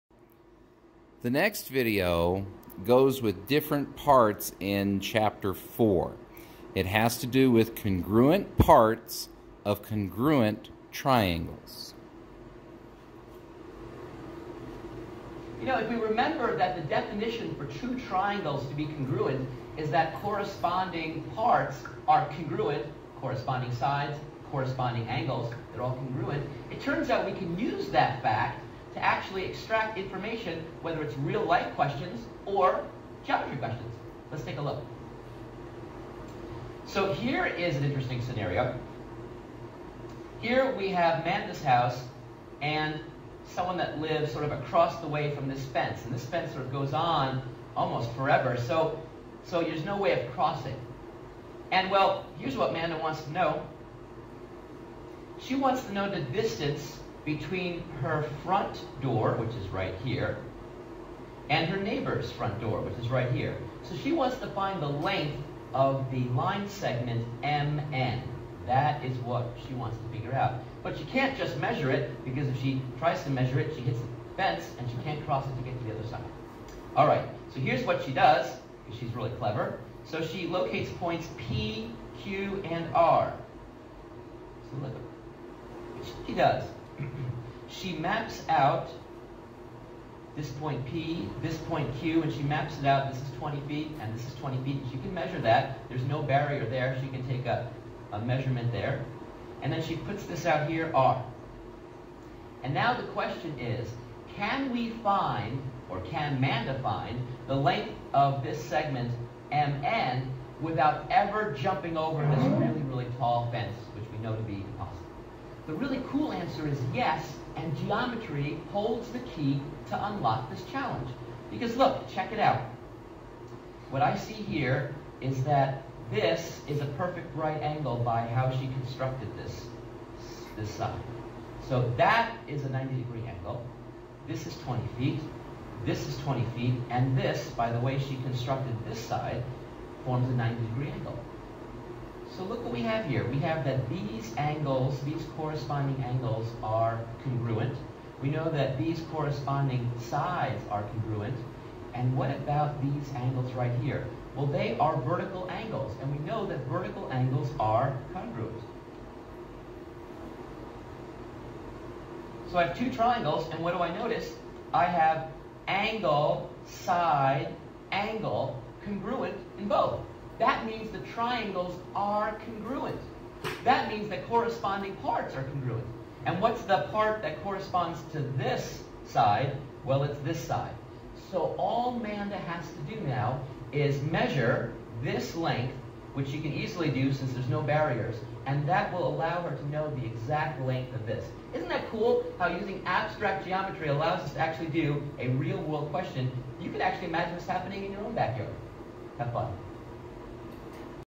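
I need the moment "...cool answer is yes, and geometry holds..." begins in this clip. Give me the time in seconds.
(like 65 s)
116 s.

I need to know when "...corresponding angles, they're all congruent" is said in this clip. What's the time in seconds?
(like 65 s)
24 s.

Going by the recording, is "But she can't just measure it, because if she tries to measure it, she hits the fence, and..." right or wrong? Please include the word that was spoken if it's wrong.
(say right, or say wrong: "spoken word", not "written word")
right.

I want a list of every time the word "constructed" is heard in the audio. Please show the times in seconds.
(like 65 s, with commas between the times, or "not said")
128 s, 138 s.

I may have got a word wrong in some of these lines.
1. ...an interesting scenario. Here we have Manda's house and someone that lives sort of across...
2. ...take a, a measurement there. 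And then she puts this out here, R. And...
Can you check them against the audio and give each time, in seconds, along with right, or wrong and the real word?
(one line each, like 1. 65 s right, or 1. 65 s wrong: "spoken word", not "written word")
1. 37 s right
2. 97 s right.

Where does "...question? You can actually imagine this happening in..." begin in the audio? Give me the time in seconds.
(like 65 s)
195 s.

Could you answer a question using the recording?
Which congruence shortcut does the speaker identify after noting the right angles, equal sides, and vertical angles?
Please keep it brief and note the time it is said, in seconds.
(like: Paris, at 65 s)
Angle, side, angle, at 165 s.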